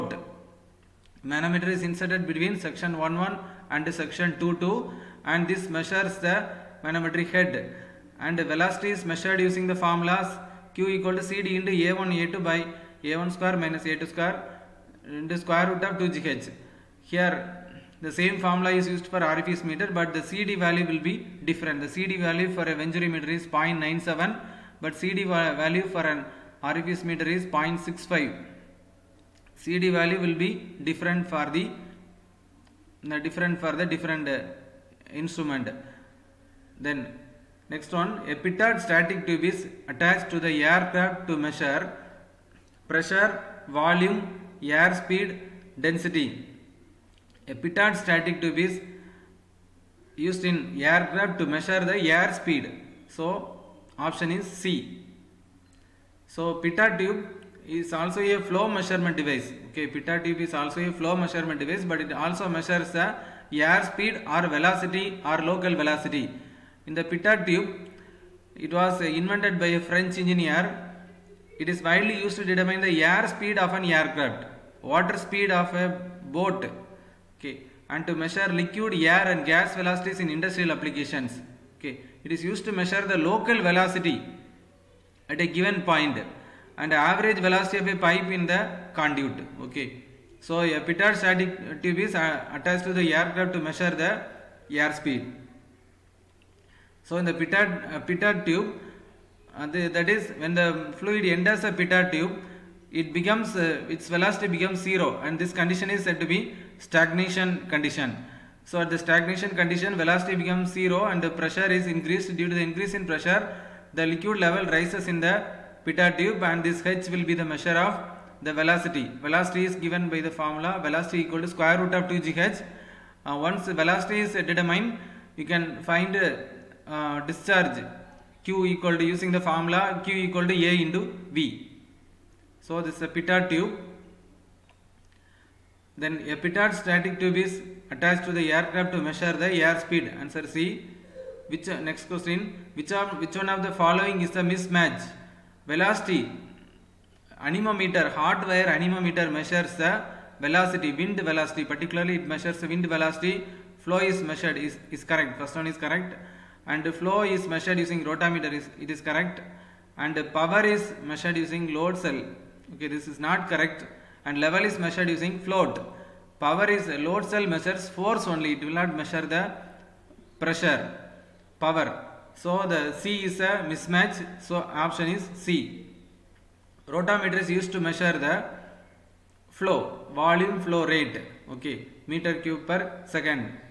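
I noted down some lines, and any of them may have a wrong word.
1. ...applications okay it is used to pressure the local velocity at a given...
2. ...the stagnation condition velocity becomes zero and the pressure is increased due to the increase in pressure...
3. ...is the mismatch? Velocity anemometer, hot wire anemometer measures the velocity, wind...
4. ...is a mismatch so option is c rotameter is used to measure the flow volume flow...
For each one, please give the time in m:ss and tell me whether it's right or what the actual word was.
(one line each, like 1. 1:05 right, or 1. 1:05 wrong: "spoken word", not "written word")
1. 1:20 wrong: "measure", not "pressure"
2. 1:48 right
3. 2:24 right
4. 2:53 right.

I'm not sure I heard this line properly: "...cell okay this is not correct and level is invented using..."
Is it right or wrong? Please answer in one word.
wrong.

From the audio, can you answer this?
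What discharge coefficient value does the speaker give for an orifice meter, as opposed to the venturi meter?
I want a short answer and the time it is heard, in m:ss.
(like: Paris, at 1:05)
0.65, at 0:27.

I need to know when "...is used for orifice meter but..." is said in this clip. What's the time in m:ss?
0:18.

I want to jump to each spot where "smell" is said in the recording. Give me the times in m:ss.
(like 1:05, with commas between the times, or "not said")
not said.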